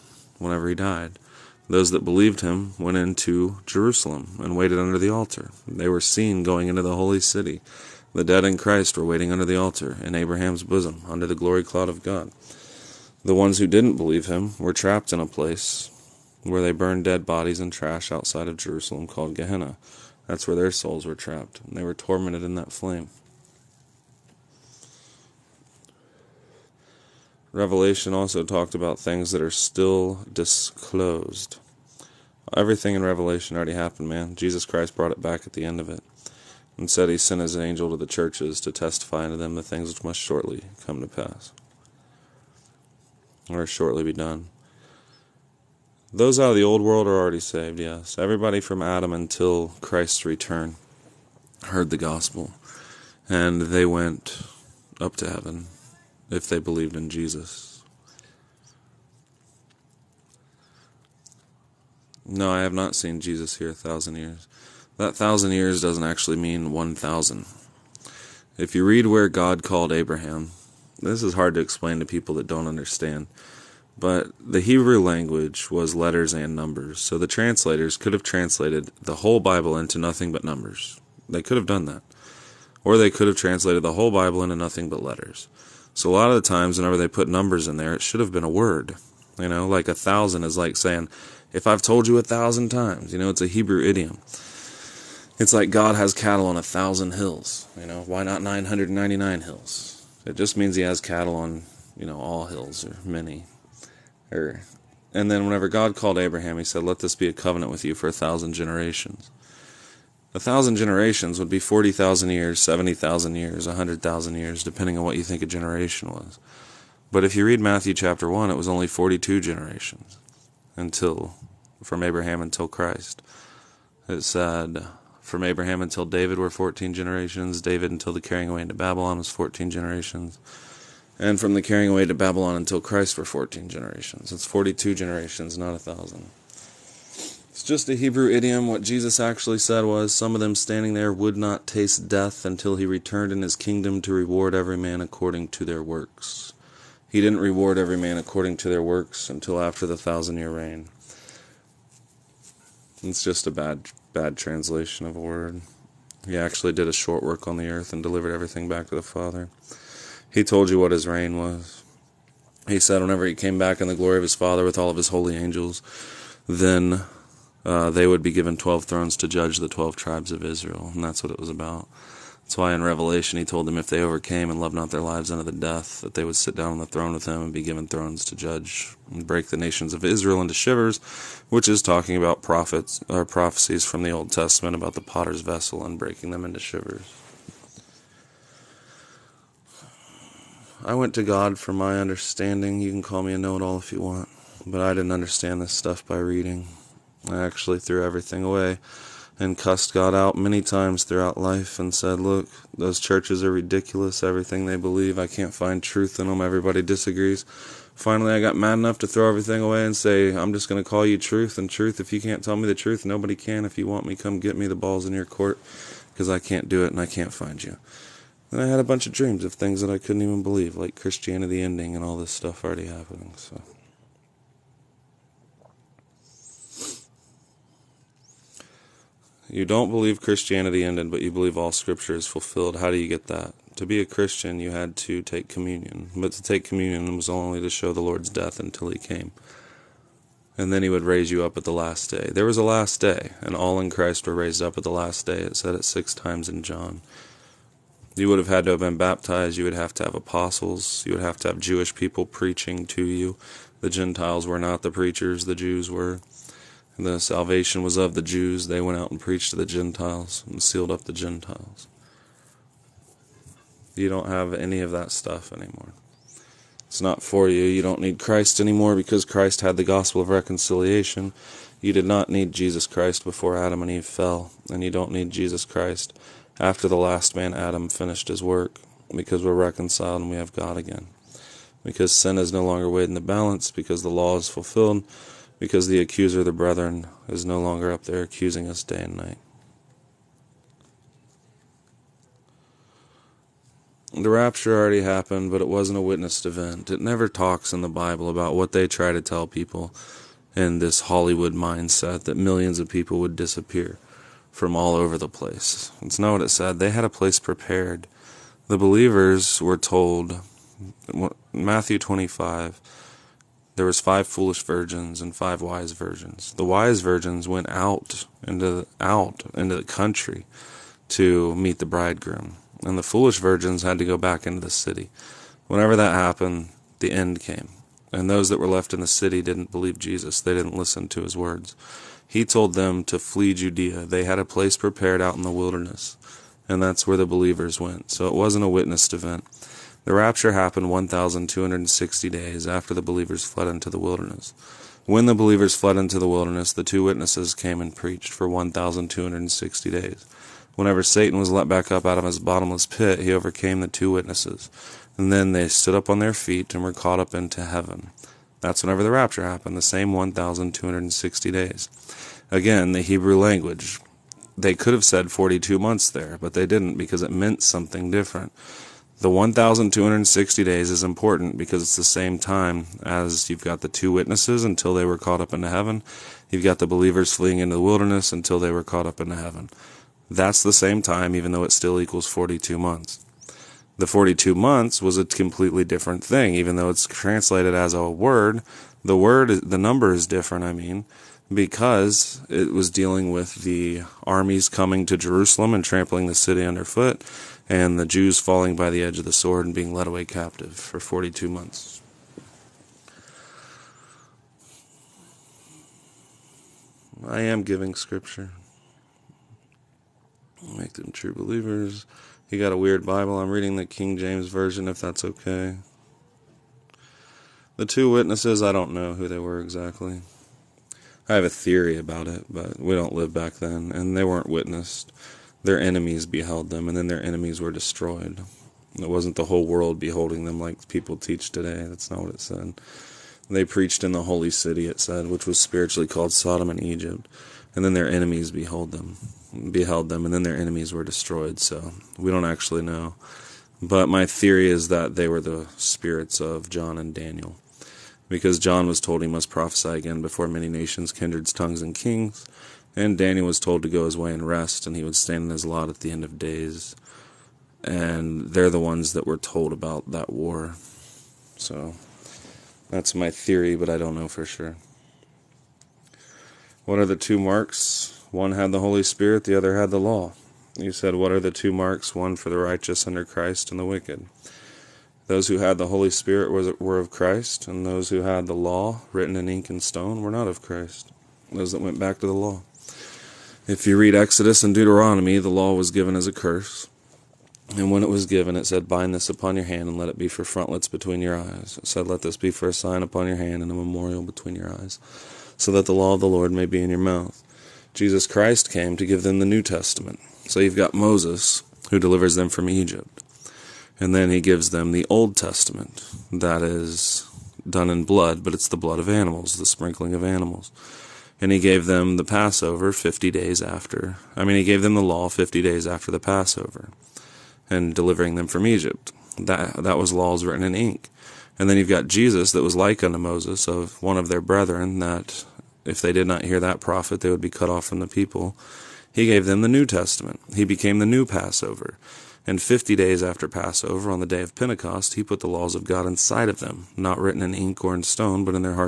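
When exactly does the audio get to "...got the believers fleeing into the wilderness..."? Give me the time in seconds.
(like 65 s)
376 s.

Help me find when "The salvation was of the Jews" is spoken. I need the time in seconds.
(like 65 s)
256 s.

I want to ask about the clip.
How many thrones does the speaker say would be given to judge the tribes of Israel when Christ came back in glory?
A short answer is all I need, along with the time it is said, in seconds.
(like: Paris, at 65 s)
12, at 168 s.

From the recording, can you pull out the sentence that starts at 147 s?
He didn't reward every man according to their works until after the thousand year reign.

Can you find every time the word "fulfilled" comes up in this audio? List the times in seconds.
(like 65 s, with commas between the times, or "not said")
232 s, 284 s.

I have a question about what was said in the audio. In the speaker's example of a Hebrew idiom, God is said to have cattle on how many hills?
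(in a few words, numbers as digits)
1000.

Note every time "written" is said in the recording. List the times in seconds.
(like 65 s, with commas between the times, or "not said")
479 s, 520 s, 537 s.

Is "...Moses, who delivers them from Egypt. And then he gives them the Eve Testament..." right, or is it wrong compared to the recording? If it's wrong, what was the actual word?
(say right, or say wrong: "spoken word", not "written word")
wrong: "Old", not "Eve".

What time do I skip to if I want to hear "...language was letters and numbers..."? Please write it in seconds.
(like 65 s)
75 s.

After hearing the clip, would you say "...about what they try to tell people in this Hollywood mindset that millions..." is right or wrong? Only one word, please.
right.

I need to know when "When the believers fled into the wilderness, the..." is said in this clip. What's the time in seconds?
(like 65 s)
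345 s.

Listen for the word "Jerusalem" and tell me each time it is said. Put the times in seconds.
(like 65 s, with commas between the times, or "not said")
3 s, 18 s, 395 s.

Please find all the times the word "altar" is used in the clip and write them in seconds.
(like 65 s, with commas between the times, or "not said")
5 s, 9 s.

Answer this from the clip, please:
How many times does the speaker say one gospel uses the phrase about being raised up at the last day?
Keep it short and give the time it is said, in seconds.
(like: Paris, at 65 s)
6, at 245 s.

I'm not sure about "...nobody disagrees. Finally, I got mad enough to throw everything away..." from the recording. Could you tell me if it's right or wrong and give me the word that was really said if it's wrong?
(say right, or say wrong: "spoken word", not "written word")
wrong: "everybody", not "nobody".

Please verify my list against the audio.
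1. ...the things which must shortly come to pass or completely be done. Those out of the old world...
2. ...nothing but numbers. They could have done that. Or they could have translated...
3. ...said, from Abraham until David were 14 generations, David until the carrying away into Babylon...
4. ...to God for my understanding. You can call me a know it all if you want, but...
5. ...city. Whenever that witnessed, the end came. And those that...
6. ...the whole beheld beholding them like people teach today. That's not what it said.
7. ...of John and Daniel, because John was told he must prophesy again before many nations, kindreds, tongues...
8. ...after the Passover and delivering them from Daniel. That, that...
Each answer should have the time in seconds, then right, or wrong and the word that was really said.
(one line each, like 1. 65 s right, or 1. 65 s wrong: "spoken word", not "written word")
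1. 39 s wrong: "shortly", not "completely"
2. 79 s right
3. 124 s right
4. 191 s right
5. 324 s wrong: "happened", not "witnessed"
6. 429 s wrong: "world", not "beheld"
7. 446 s right
8. 515 s wrong: "Egypt", not "Daniel".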